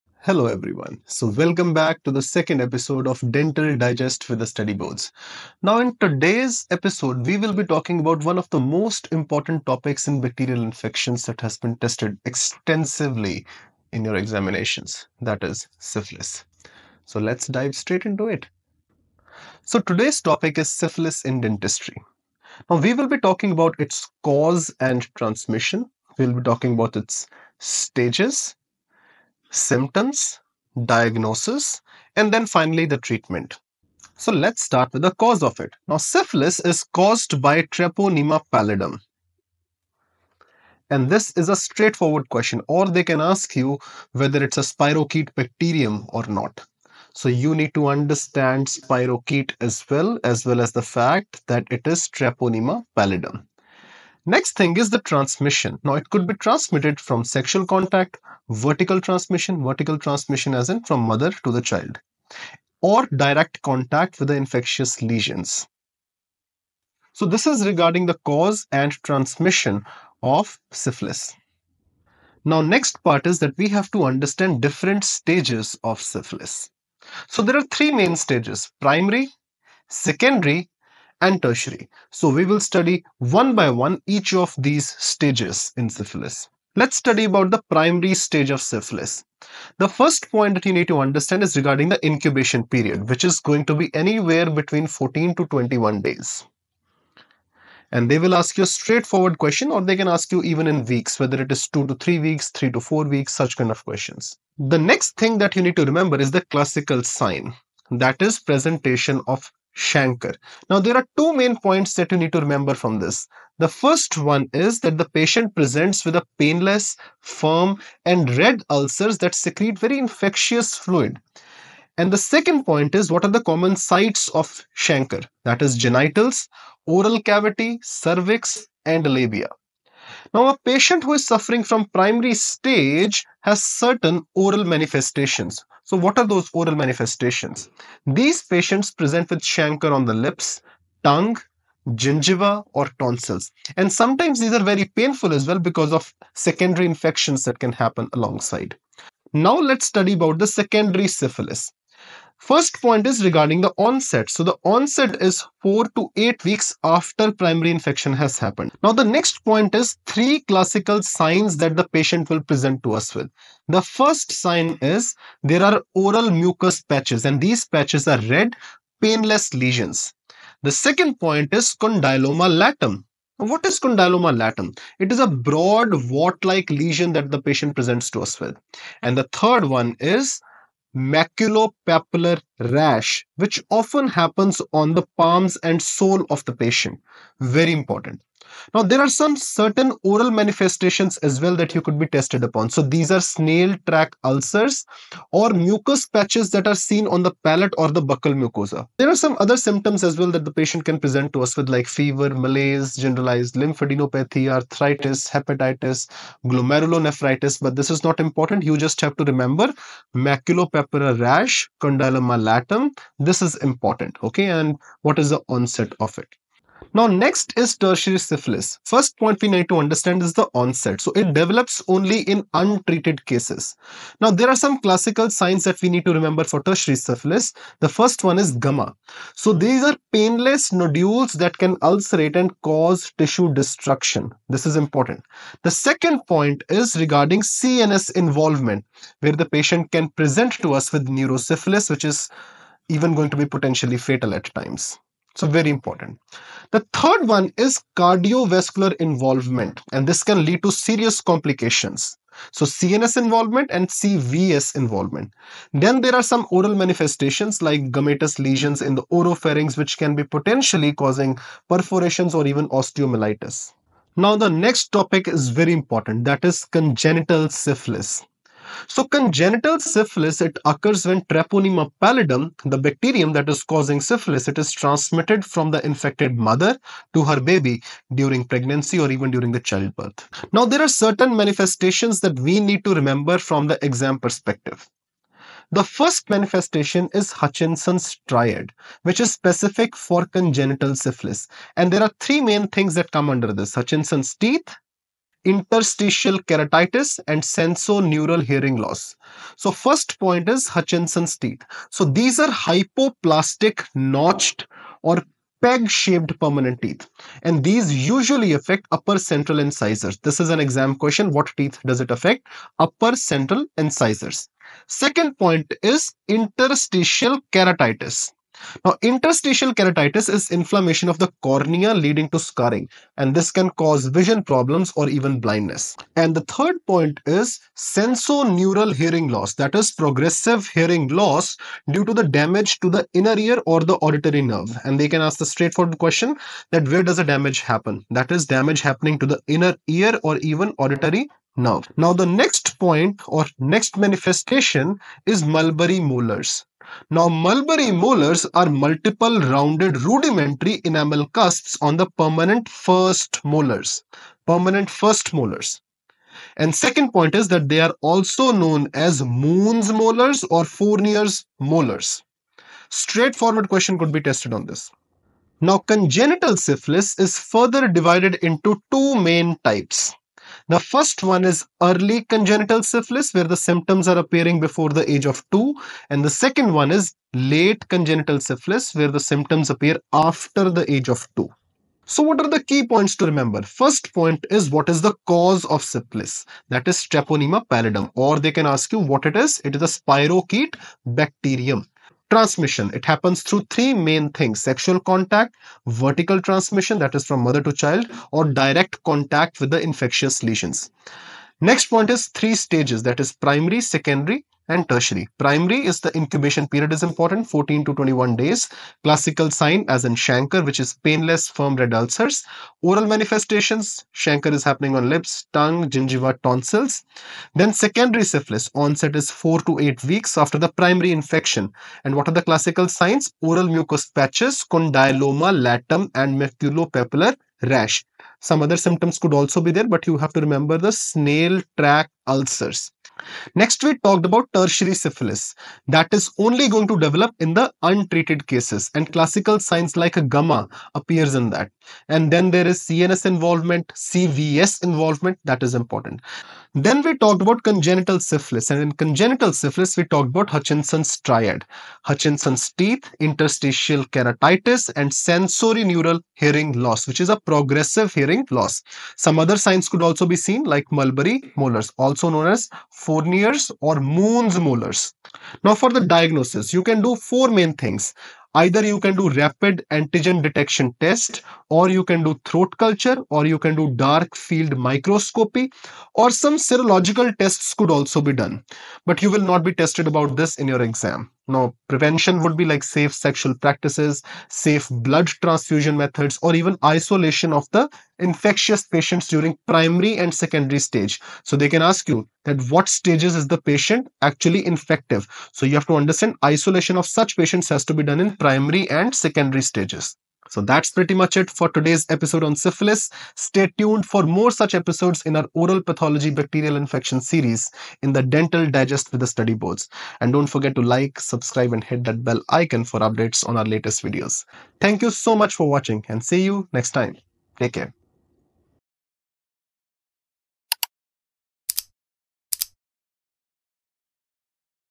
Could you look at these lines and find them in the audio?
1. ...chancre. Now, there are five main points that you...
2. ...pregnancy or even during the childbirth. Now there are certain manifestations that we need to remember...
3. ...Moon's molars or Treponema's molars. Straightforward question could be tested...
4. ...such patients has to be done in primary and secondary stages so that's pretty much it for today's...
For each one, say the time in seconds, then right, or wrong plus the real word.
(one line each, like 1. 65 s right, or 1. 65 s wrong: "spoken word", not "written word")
1. 109 s wrong: "two", not "five"
2. 278 s right
3. 359 s wrong: "Fournier", not "Treponema"
4. 497 s right.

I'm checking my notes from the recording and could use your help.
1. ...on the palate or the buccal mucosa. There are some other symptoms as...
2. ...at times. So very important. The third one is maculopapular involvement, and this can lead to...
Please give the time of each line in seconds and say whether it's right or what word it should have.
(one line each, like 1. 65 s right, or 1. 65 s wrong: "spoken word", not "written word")
1. 197 s right
2. 244 s wrong: "cardiovascular", not "maculopapular".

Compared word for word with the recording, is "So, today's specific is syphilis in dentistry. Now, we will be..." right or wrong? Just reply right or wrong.
wrong.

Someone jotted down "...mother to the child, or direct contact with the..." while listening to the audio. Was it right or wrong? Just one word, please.
right.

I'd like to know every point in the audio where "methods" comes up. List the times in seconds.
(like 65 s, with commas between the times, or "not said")
485 s.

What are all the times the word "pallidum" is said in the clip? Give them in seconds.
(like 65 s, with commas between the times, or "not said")
38 s, 52 s, 272 s, 387 s.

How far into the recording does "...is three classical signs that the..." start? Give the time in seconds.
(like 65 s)
159 s.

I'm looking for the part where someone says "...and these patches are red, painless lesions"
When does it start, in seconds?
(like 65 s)
167 s.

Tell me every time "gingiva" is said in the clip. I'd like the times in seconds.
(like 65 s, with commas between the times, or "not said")
141 s, 415 s.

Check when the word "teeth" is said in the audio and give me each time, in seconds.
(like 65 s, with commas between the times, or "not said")
294 s, 301 s, 306 s, 311 s, 452 s.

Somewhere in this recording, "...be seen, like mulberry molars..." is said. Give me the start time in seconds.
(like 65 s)
460 s.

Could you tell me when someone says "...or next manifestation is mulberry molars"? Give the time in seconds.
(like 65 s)
343 s.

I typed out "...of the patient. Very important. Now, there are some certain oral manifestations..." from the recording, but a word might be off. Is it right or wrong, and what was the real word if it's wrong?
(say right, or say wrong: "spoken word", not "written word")
right.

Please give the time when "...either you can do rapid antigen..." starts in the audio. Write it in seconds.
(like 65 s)
468 s.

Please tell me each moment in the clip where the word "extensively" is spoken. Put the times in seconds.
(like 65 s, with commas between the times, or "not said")
12 s.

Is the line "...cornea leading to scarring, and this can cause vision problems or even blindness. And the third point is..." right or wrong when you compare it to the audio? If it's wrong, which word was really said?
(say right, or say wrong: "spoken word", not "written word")
right.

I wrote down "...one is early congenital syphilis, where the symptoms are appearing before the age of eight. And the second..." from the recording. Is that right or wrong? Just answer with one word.
wrong.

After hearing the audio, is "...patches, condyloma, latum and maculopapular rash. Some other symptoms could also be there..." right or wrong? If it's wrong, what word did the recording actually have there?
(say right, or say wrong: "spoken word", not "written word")
right.